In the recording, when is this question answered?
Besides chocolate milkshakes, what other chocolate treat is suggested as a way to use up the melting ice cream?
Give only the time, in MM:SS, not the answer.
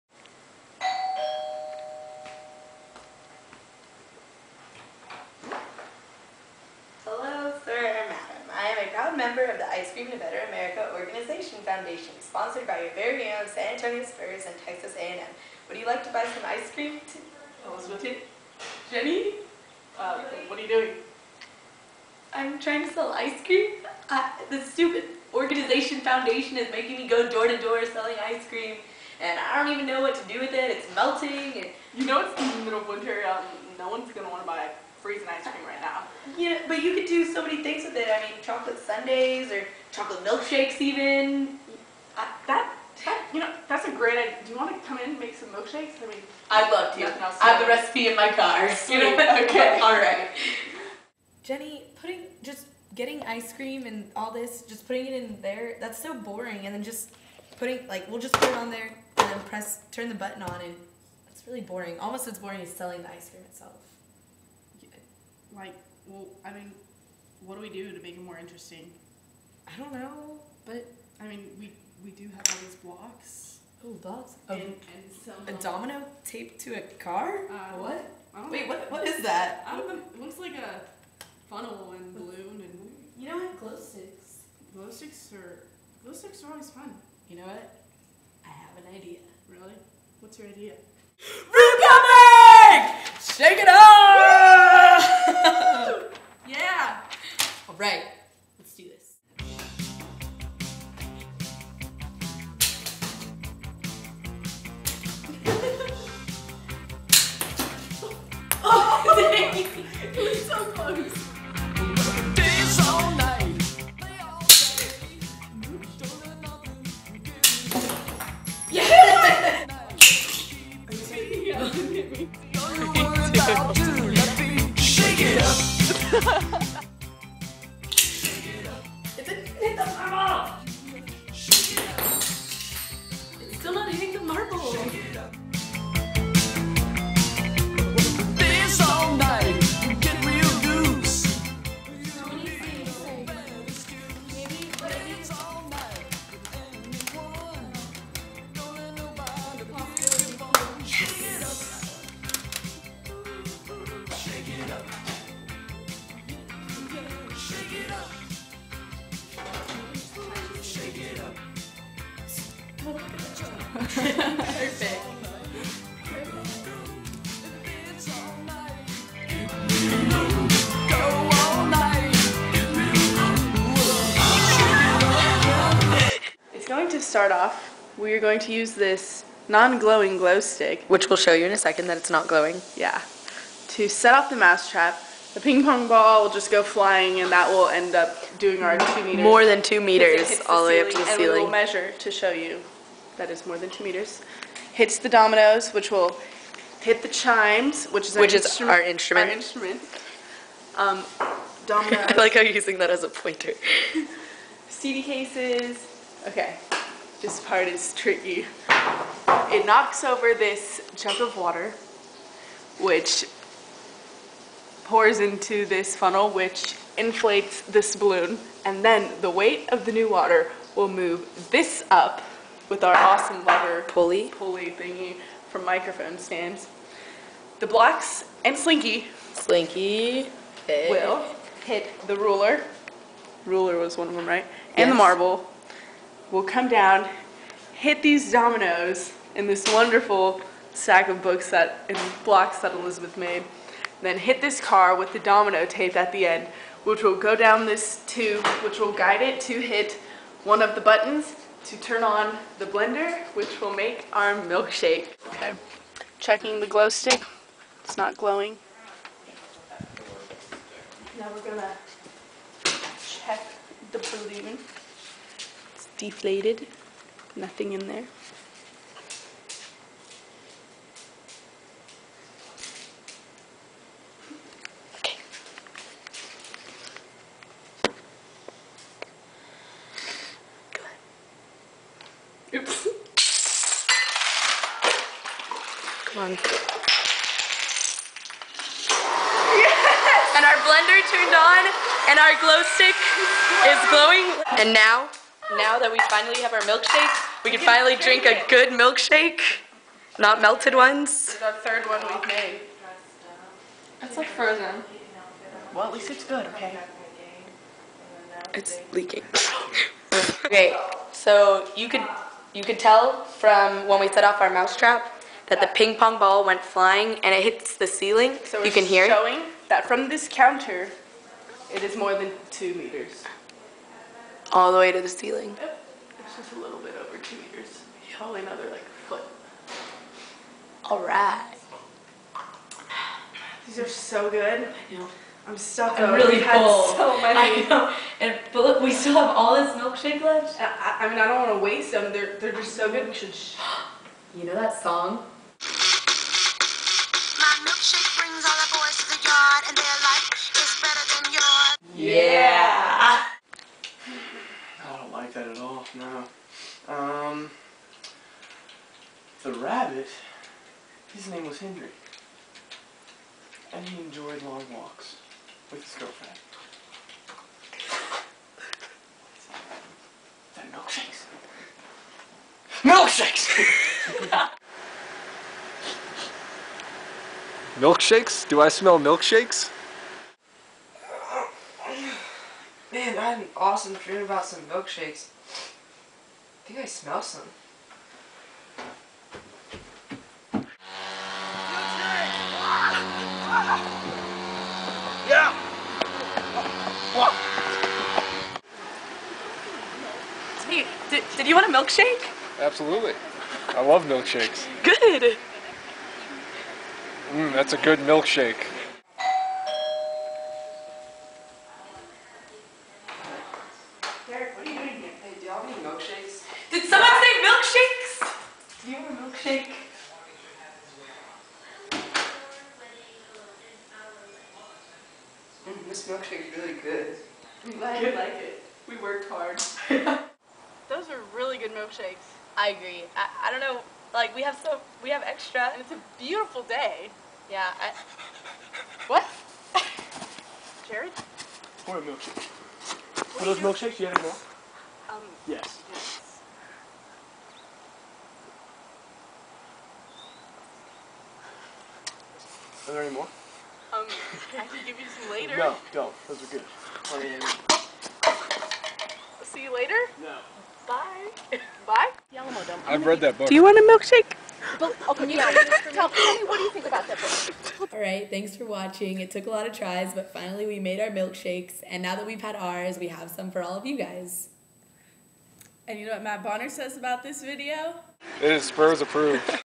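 00:38.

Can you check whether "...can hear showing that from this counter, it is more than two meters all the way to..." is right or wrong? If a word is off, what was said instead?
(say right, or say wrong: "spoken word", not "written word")
right.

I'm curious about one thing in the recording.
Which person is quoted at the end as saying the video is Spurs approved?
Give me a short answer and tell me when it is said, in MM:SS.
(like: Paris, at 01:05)
Matt Bonner, at 07:56.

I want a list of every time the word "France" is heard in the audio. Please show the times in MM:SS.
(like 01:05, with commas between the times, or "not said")
not said.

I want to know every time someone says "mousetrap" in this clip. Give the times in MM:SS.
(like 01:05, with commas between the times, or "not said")
03:04, 05:14.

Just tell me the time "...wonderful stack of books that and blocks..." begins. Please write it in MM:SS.
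03:59.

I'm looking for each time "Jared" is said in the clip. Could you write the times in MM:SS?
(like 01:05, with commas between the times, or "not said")
07:20.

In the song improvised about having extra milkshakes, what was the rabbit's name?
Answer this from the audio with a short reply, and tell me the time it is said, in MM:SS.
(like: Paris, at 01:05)
Henry, at 06:01.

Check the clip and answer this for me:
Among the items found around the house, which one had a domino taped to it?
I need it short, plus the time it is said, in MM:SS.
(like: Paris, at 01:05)
A car, at 01:16.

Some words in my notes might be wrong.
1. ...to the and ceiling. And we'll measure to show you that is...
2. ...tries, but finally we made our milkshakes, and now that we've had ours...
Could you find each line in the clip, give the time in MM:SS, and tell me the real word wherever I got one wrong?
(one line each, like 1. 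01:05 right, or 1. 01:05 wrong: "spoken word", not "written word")
1. 03:10 right
2. 07:49 right.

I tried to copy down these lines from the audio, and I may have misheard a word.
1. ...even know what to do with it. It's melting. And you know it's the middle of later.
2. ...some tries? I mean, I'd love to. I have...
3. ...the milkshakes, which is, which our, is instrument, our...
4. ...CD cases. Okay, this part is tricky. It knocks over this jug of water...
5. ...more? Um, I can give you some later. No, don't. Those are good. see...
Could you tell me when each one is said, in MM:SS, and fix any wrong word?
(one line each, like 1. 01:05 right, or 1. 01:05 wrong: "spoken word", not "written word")
1. 00:29 wrong: "winter", not "later"
2. 00:45 wrong: "milkshakes", not "tries"
3. 03:17 wrong: "chimes", not "milkshakes"
4. 03:24 right
5. 07:33 right.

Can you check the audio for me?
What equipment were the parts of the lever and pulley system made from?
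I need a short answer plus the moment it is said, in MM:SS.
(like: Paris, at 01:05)
Microphone stands, at 03:45.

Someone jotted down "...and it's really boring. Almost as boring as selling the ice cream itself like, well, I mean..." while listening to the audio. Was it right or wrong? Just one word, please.
right.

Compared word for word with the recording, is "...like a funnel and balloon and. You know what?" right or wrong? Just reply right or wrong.
right.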